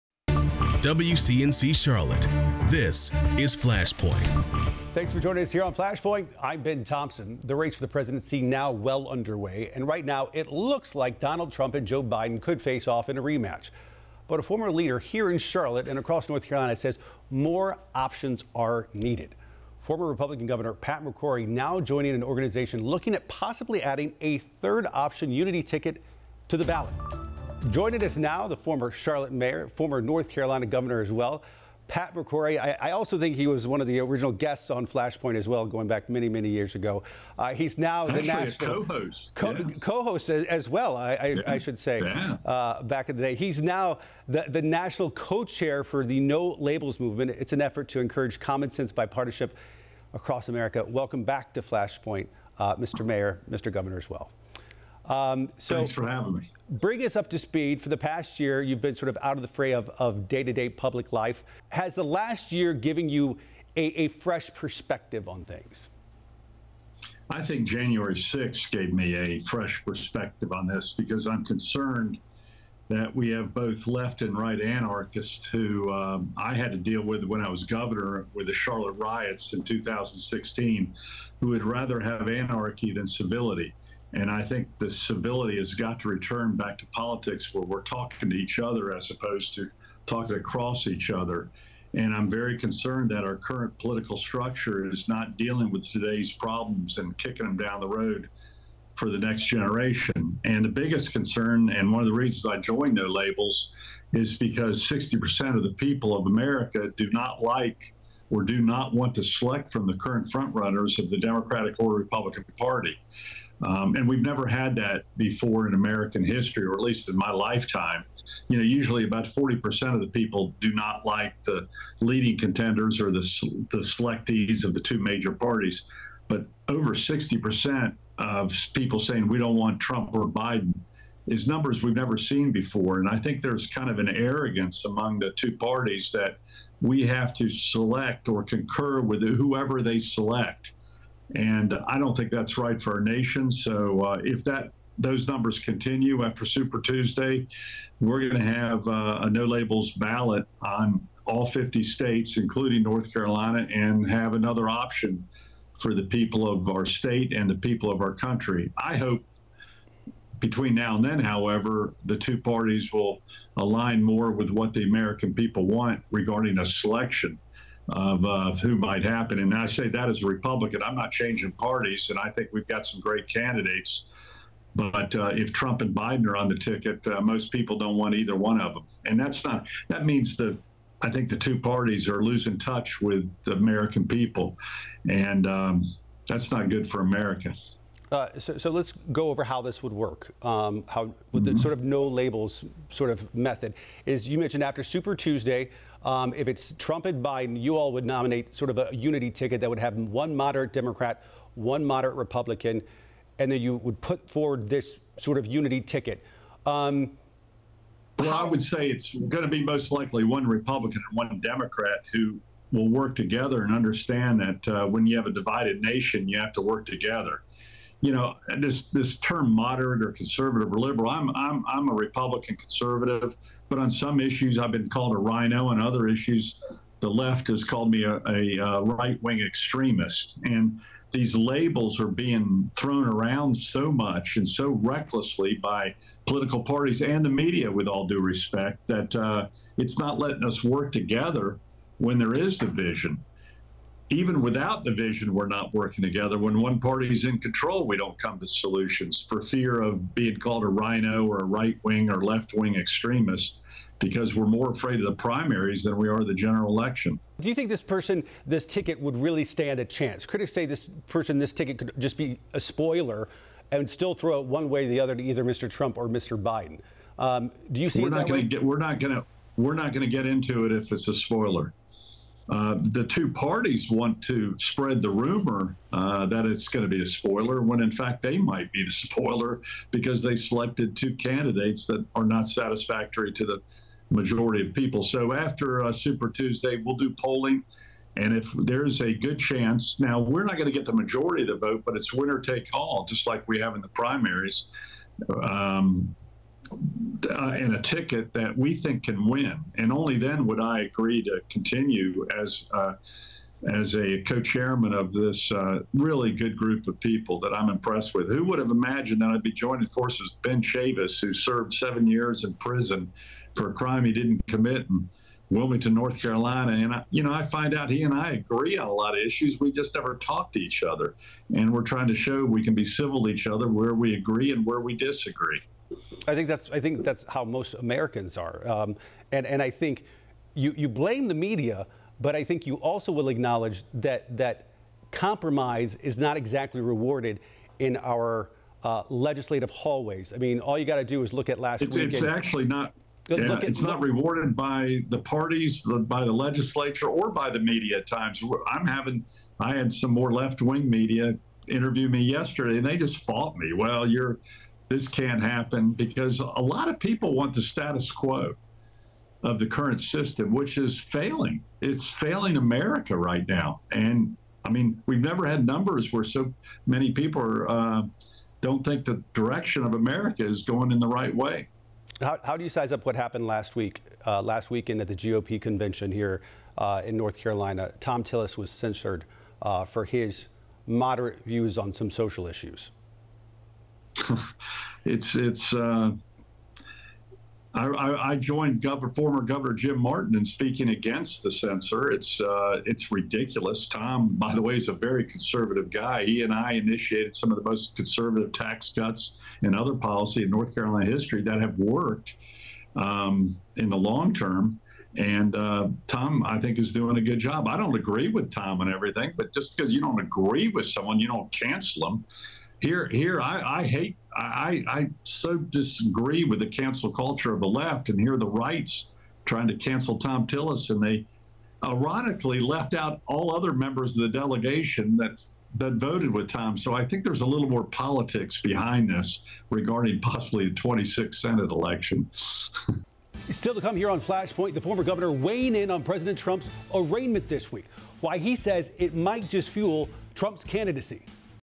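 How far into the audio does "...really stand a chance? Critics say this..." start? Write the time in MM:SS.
04:19.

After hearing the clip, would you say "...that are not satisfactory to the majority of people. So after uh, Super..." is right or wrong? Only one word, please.
right.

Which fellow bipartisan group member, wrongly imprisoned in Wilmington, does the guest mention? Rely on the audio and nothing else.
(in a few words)
Ben Chavis.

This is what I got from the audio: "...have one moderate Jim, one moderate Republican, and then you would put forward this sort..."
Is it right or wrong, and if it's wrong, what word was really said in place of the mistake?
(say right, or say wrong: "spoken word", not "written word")
wrong: "Democrat", not "Jim".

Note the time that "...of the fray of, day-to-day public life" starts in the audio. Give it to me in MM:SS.
00:59.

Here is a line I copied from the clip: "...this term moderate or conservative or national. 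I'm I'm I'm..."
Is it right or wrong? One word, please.
wrong.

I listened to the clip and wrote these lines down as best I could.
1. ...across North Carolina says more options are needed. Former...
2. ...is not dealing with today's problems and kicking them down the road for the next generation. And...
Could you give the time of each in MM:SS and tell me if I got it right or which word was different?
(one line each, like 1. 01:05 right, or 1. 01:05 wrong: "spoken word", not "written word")
1. 00:15 right
2. 01:34 right.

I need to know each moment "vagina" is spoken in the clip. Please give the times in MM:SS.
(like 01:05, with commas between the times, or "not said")
not said.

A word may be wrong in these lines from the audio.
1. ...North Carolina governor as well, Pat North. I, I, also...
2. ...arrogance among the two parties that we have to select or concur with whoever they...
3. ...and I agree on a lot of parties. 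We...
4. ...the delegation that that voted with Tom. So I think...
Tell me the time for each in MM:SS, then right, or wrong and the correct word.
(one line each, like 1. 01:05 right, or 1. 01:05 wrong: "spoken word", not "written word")
1. 00:30 wrong: "McCrory", not "North"
2. 02:14 right
3. 05:18 wrong: "issues", not "parties"
4. 07:04 right.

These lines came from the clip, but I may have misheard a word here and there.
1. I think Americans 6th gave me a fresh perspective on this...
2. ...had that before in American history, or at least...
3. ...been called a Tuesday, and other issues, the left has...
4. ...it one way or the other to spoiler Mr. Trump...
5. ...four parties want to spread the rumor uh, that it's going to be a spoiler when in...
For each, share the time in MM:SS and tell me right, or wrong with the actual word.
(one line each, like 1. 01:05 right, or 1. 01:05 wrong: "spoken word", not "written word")
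1. 01:07 wrong: "January", not "Americans"
2. 01:54 right
3. 03:44 wrong: "RINO", not "Tuesday"
4. 04:24 wrong: "either", not "spoiler"
5. 04:33 wrong: "two", not "four".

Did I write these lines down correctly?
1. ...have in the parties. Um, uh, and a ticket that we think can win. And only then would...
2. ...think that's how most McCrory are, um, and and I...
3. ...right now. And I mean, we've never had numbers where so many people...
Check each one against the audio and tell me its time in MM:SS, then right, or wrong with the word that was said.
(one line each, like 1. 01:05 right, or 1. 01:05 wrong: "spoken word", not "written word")
1. 04:53 wrong: "primaries", not "parties"
2. 05:26 wrong: "Americans", not "McCrory"
3. 06:03 right.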